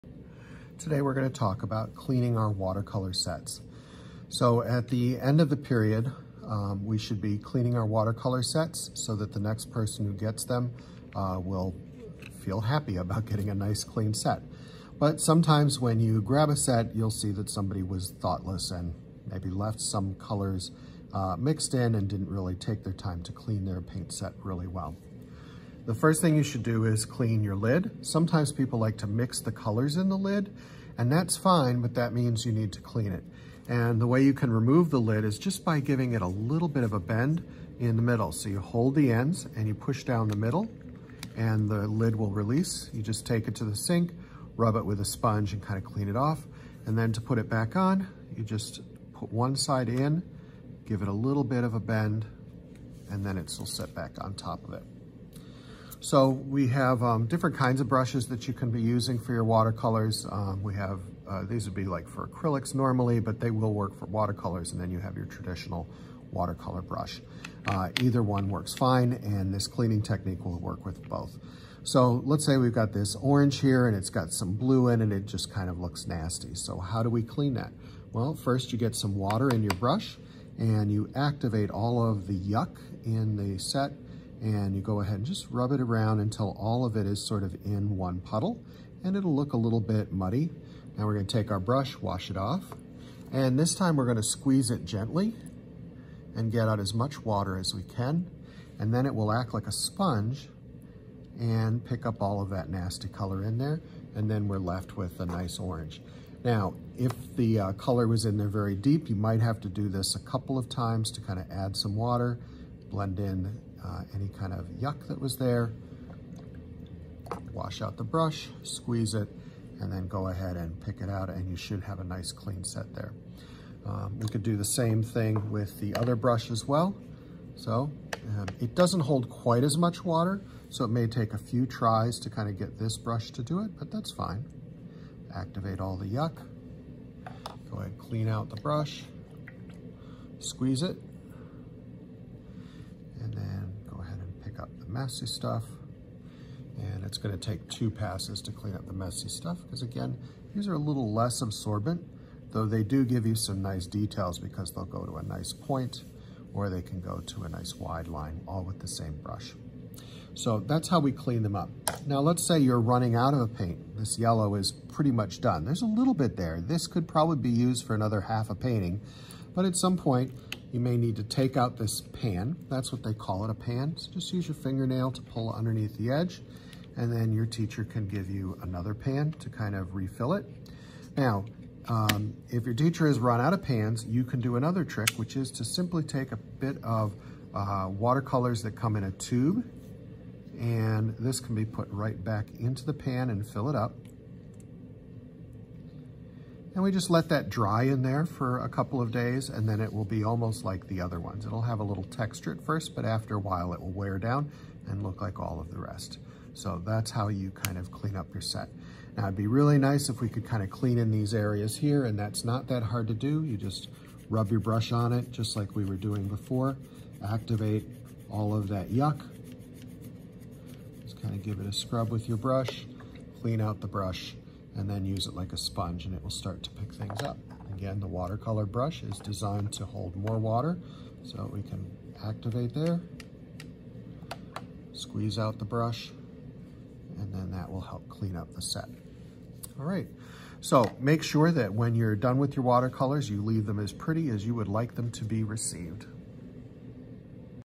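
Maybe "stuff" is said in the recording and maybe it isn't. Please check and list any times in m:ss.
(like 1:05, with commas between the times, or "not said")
2:25, 2:29.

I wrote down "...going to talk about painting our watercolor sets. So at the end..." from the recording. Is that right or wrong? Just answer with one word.
wrong.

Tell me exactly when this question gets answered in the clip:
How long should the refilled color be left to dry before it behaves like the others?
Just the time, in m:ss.
3:18.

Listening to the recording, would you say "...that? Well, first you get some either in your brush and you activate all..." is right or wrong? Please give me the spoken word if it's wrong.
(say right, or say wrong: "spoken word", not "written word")
wrong: "water", not "either".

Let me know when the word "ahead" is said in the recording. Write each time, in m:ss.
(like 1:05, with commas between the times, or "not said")
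1:25, 2:00, 2:17.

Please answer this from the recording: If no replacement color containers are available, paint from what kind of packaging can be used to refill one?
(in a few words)
a tube.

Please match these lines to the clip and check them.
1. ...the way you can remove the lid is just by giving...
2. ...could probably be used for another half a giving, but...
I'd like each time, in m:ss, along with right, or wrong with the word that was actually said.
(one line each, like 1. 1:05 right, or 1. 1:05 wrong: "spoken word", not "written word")
1. 0:33 right
2. 2:46 wrong: "painting", not "giving".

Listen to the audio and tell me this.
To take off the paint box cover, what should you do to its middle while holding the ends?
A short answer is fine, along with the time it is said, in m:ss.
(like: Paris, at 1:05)
Push down, at 0:39.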